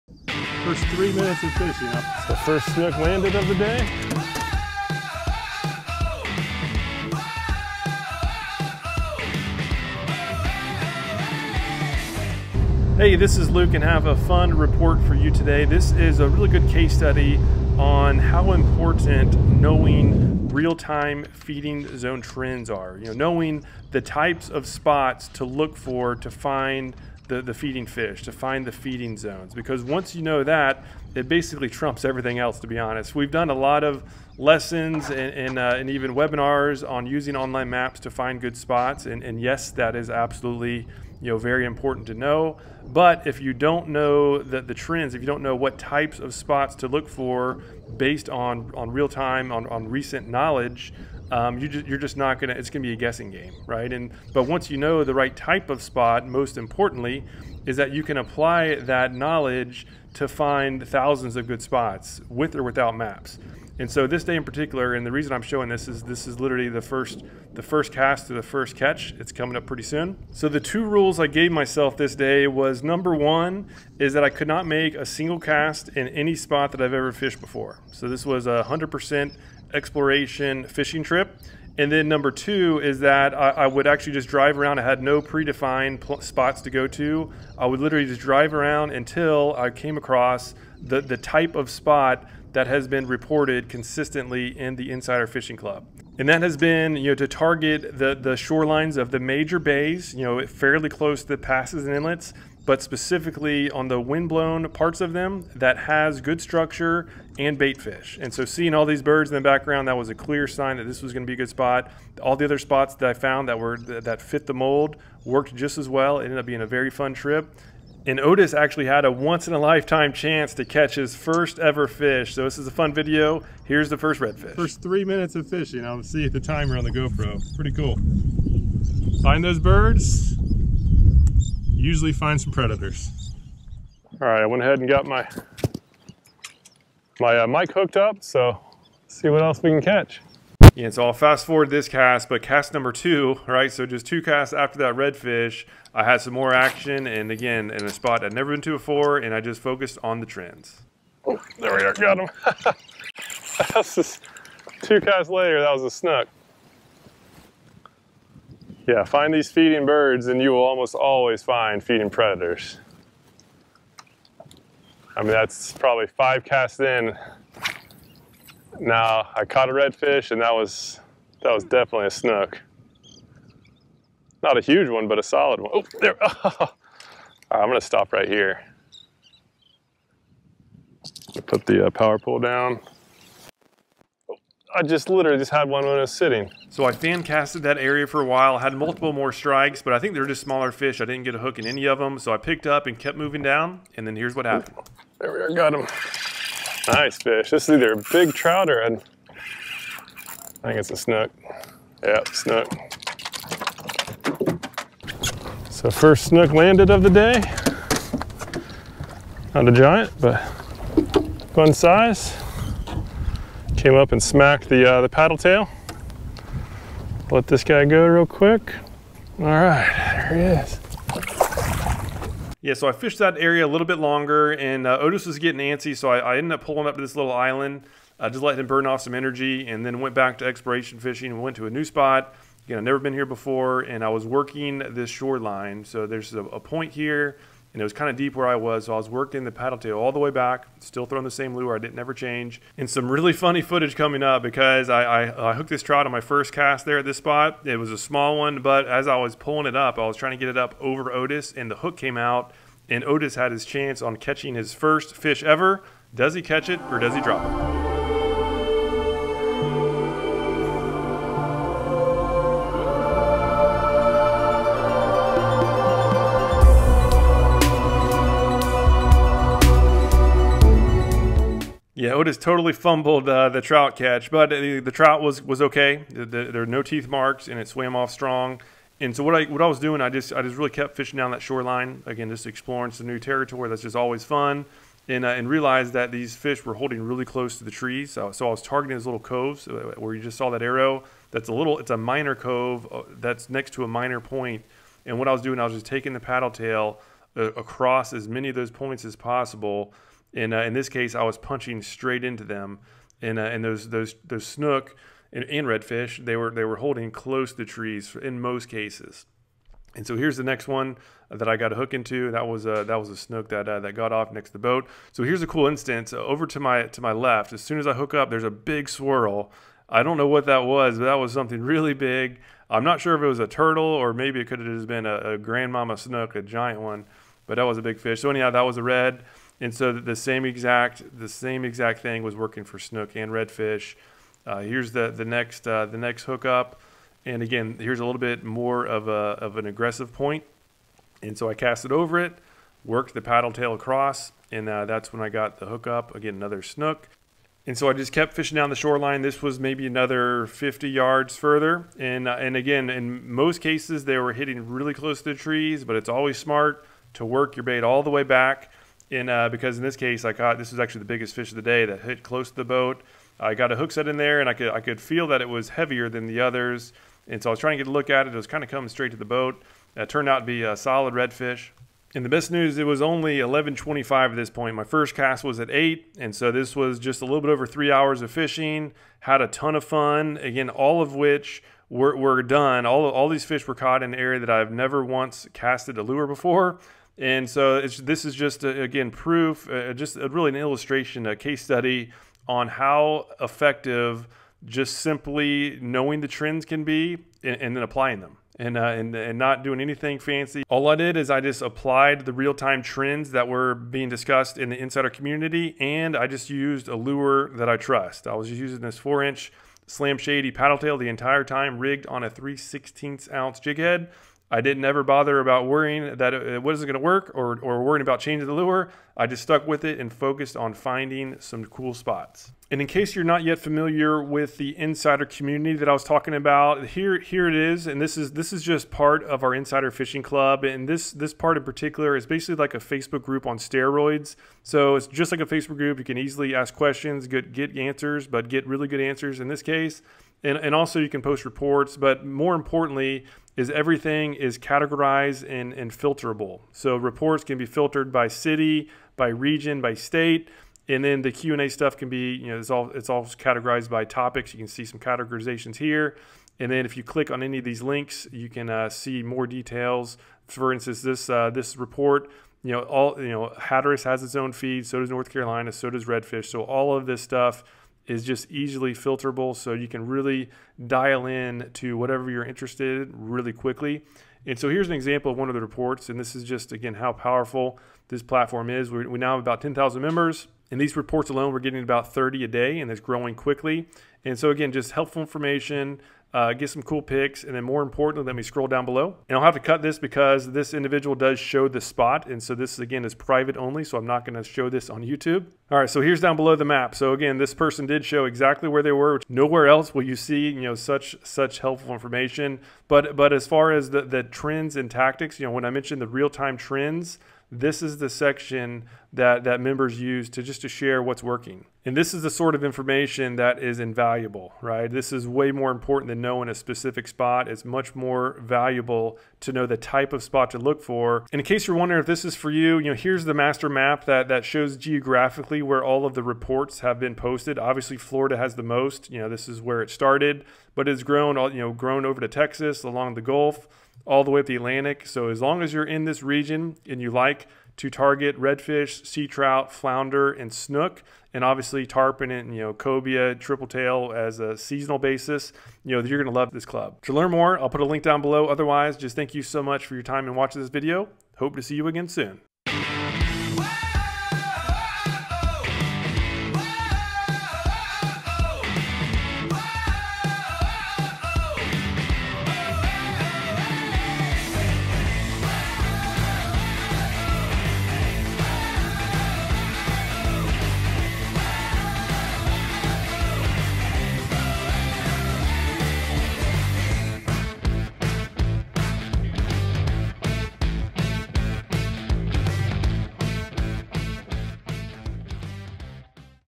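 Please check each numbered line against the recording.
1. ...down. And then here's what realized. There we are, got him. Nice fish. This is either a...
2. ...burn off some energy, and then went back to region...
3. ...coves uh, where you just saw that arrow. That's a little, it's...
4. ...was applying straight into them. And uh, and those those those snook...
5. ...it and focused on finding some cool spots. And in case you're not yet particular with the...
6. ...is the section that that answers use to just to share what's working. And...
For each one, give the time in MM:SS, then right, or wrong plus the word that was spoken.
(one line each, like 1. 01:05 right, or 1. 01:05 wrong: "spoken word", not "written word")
1. 03:13 wrong: "happened", not "realized"
2. 03:48 wrong: "exploration", not "region"
3. 04:49 right
4. 05:01 wrong: "punching", not "applying"
5. 06:59 wrong: "familiar", not "particular"
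6. 08:27 wrong: "members", not "answers".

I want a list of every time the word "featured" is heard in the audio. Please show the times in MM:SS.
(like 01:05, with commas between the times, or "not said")
not said.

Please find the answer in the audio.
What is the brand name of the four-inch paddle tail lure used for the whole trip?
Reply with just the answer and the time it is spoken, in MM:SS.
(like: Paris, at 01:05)
Slam Shady, at 06:49.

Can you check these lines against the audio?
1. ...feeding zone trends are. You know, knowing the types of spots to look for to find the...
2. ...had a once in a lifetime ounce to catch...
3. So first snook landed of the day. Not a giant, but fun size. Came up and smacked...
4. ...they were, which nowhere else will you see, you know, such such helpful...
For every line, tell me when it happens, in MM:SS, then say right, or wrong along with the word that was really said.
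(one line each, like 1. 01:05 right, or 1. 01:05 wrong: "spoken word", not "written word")
1. 00:21 right
2. 01:58 wrong: "chance", not "ounce"
3. 03:25 right
4. 08:18 right.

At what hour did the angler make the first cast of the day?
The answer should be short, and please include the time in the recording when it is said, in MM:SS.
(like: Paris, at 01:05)
8, at 06:15.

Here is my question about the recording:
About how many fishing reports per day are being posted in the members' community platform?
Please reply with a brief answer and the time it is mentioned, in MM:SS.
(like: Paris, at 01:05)
30, at 08:01.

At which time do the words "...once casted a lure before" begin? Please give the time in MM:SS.
06:25.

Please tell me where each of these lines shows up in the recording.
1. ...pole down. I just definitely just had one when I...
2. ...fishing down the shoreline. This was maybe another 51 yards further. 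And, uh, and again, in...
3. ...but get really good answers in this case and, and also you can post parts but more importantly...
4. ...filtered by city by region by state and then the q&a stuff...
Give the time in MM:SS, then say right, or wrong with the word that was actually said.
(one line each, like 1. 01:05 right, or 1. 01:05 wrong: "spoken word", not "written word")
1. 03:02 wrong: "literally", not "definitely"
2. 05:48 wrong: "50", not "51"
3. 07:18 wrong: "reports", not "parts"
4. 07:27 right.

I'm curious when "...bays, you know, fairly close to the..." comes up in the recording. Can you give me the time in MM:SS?
01:39.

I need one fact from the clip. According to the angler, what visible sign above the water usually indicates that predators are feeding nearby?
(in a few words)
feeding birds.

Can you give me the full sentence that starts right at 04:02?
And some really funny footage coming up because I, I, I, hooked this trout on my first cast there at this spot.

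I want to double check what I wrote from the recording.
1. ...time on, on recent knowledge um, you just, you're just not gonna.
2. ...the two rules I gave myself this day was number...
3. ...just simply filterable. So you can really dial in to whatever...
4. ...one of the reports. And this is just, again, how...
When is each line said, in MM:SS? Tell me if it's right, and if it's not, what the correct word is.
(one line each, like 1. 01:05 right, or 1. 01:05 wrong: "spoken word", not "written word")
1. 00:49 right
2. 01:10 right
3. 07:48 wrong: "easily", not "simply"
4. 07:55 right.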